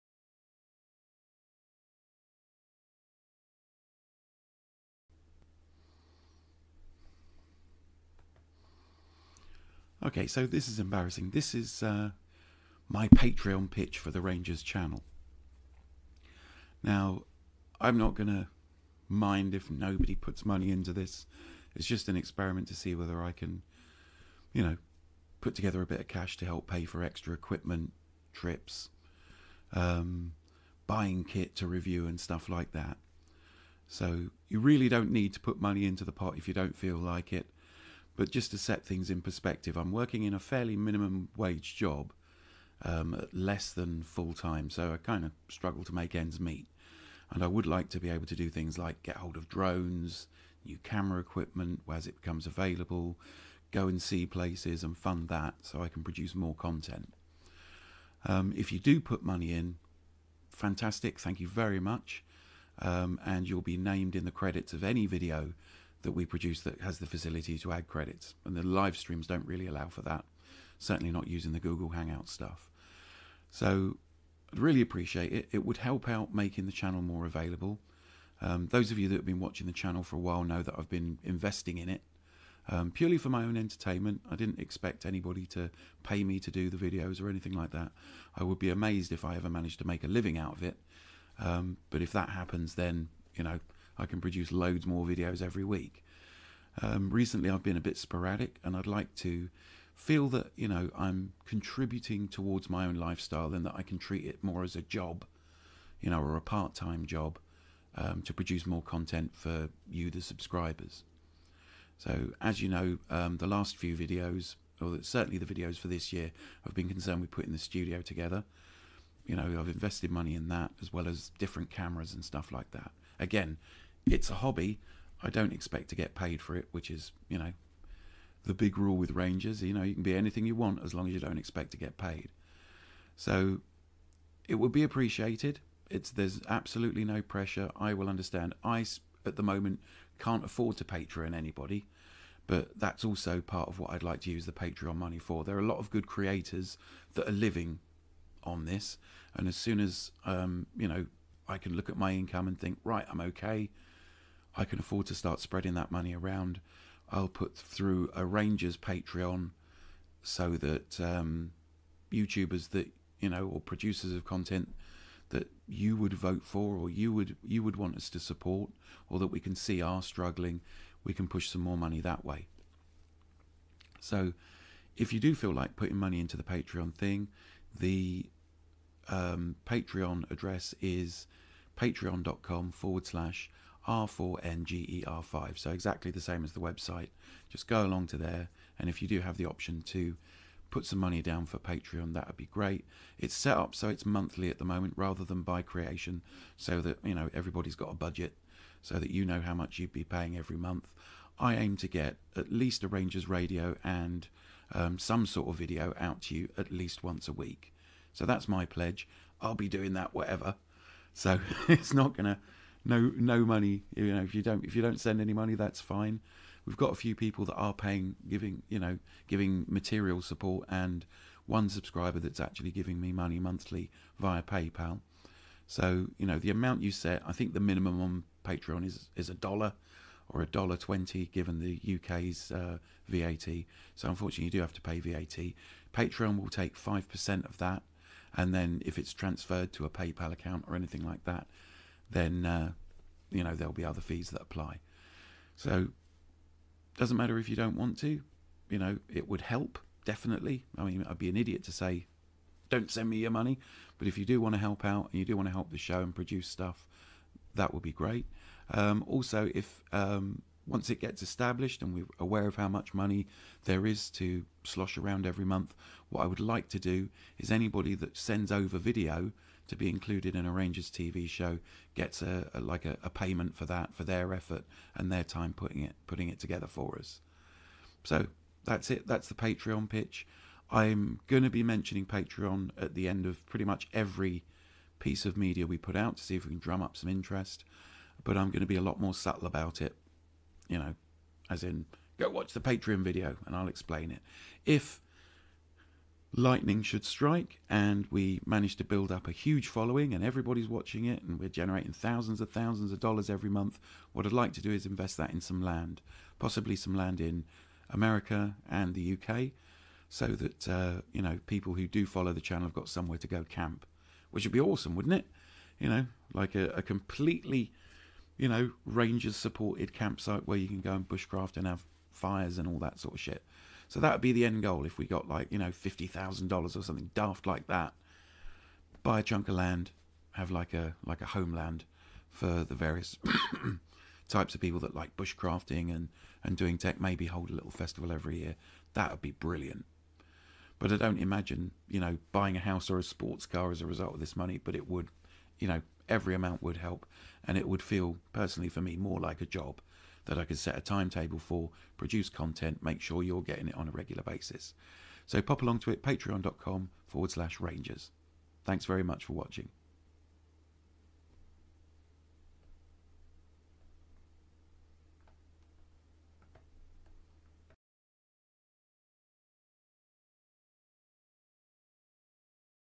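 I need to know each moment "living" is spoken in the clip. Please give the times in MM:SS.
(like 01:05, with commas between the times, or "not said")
01:30, 02:27.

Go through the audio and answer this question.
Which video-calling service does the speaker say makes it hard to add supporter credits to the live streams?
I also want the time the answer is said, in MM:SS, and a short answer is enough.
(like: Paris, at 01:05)
Google Hangout, at 01:11.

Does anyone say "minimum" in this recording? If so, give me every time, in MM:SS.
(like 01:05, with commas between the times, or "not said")
00:40, 03:47.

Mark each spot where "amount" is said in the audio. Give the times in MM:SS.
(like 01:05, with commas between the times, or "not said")
03:46, 05:46.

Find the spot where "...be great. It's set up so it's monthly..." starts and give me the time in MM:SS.
03:12.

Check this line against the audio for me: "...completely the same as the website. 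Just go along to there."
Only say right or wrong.
wrong.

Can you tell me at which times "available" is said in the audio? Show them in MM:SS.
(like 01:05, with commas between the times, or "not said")
00:52, 01:17.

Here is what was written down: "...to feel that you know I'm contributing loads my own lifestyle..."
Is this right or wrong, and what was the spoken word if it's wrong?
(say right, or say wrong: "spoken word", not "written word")
wrong: "towards", not "loads".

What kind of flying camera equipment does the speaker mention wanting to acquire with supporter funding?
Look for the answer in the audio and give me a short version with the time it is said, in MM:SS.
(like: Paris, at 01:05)
drones, at 00:49.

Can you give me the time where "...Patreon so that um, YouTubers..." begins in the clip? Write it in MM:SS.
02:38.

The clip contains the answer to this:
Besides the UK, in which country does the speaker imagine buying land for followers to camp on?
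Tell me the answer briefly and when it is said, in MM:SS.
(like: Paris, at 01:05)
America, at 05:07.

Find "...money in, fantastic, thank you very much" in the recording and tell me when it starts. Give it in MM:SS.
00:59.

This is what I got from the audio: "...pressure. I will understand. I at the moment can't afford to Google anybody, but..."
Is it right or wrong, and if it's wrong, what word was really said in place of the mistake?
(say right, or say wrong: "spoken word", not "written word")
wrong: "Patreon", not "Google".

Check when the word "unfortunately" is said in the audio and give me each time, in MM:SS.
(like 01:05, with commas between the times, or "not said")
03:54.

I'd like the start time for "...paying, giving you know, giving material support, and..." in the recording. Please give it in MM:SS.
03:37.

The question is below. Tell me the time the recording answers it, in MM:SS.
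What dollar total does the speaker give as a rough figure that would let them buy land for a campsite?
05:25.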